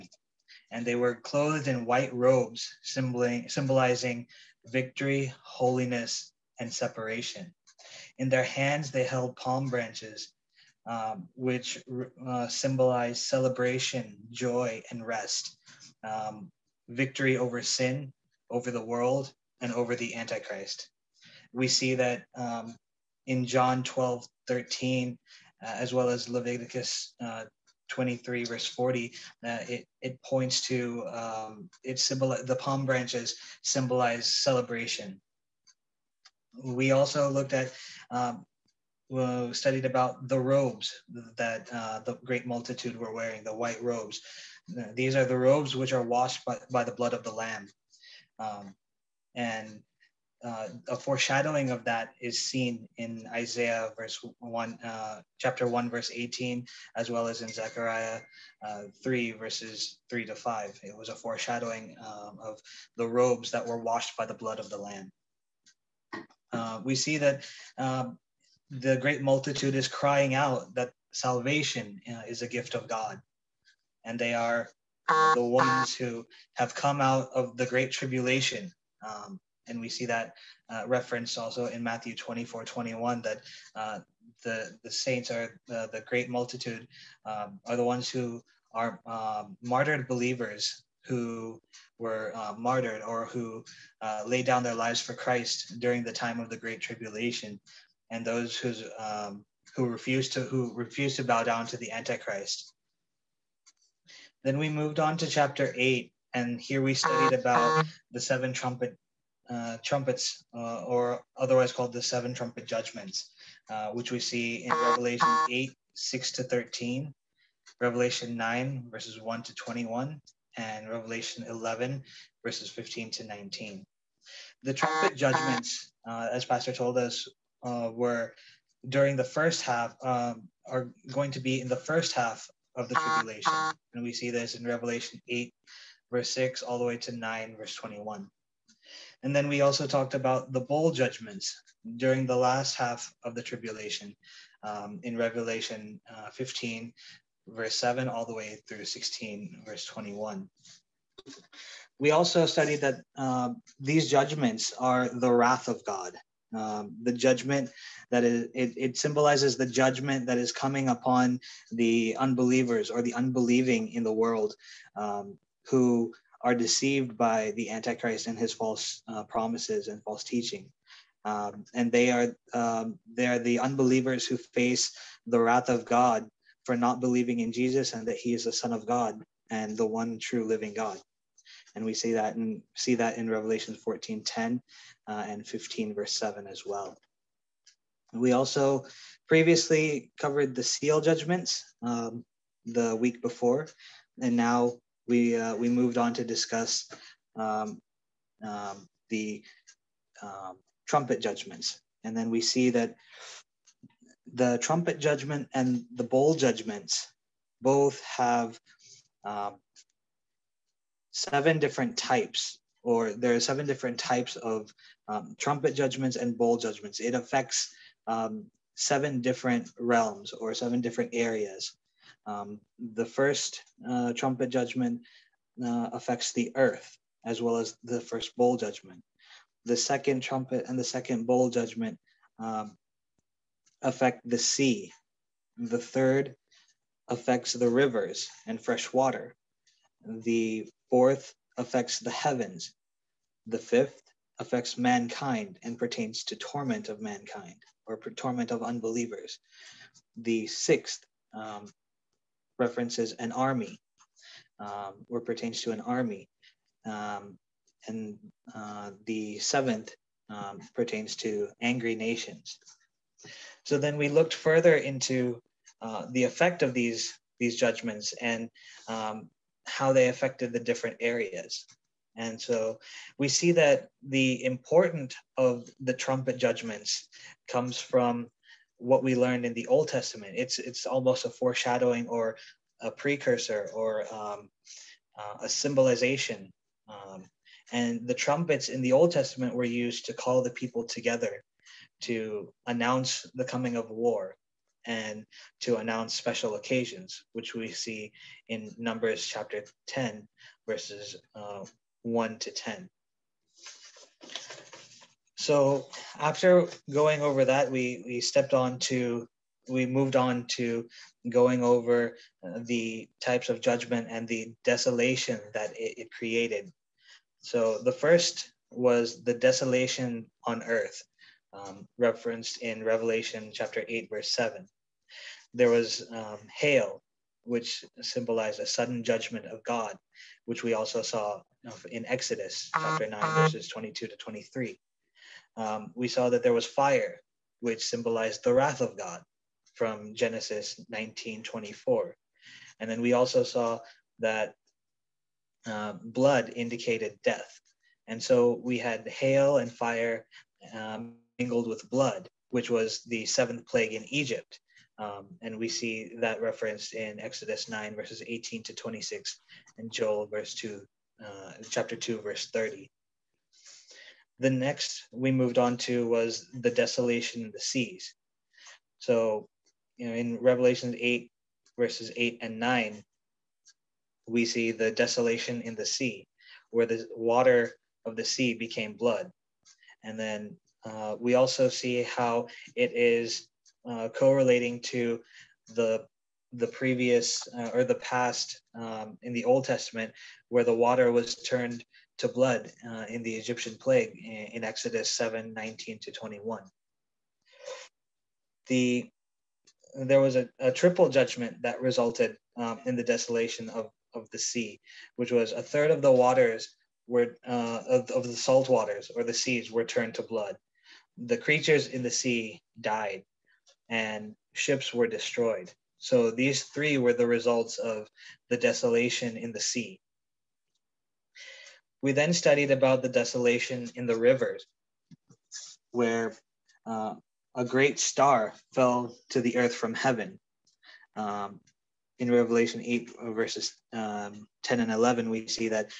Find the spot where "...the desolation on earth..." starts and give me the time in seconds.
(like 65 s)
319 s.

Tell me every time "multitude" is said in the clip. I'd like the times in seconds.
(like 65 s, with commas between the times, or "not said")
42 s, 69 s, 86 s.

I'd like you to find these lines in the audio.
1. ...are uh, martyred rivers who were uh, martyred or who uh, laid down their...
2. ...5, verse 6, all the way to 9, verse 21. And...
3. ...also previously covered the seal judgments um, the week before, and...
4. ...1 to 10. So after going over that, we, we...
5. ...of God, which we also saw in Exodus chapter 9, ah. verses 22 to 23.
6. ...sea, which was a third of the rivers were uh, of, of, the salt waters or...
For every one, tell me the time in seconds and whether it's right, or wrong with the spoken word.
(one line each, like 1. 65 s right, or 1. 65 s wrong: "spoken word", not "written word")
1. 88 s wrong: "believers", not "rivers"
2. 135 s wrong: "8", not "5"
3. 188 s right
4. 302 s right
5. 329 s right
6. 404 s wrong: "waters", not "rivers".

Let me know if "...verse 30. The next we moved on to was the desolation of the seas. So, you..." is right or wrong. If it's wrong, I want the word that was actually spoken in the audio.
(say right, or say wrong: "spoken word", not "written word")
right.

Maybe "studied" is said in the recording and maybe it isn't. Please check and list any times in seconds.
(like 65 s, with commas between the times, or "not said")
39 s, 106 s, 152 s, 422 s.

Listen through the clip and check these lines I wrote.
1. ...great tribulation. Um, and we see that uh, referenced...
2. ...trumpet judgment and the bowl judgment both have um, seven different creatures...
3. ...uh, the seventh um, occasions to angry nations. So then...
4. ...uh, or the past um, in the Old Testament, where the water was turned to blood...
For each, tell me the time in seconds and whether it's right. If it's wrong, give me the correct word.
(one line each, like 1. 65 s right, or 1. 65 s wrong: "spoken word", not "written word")
1. 77 s right
2. 204 s wrong: "types", not "creatures"
3. 258 s wrong: "pertains", not "occasions"
4. 387 s right.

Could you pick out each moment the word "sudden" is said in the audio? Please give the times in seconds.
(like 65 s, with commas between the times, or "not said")
328 s.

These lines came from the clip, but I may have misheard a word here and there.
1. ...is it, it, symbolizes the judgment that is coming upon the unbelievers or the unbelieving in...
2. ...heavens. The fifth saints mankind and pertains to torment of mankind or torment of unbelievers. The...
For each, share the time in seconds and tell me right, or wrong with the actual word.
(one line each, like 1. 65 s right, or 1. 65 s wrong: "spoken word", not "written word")
1. 158 s right
2. 242 s wrong: "affects", not "saints".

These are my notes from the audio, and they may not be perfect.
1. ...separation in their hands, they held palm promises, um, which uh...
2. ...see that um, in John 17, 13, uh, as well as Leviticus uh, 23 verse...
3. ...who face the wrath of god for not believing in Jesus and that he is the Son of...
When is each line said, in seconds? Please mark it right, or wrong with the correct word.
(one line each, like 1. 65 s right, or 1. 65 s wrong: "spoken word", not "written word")
1. 6 s wrong: "branches", not "promises"
2. 21 s wrong: "12", not "17"
3. 174 s right.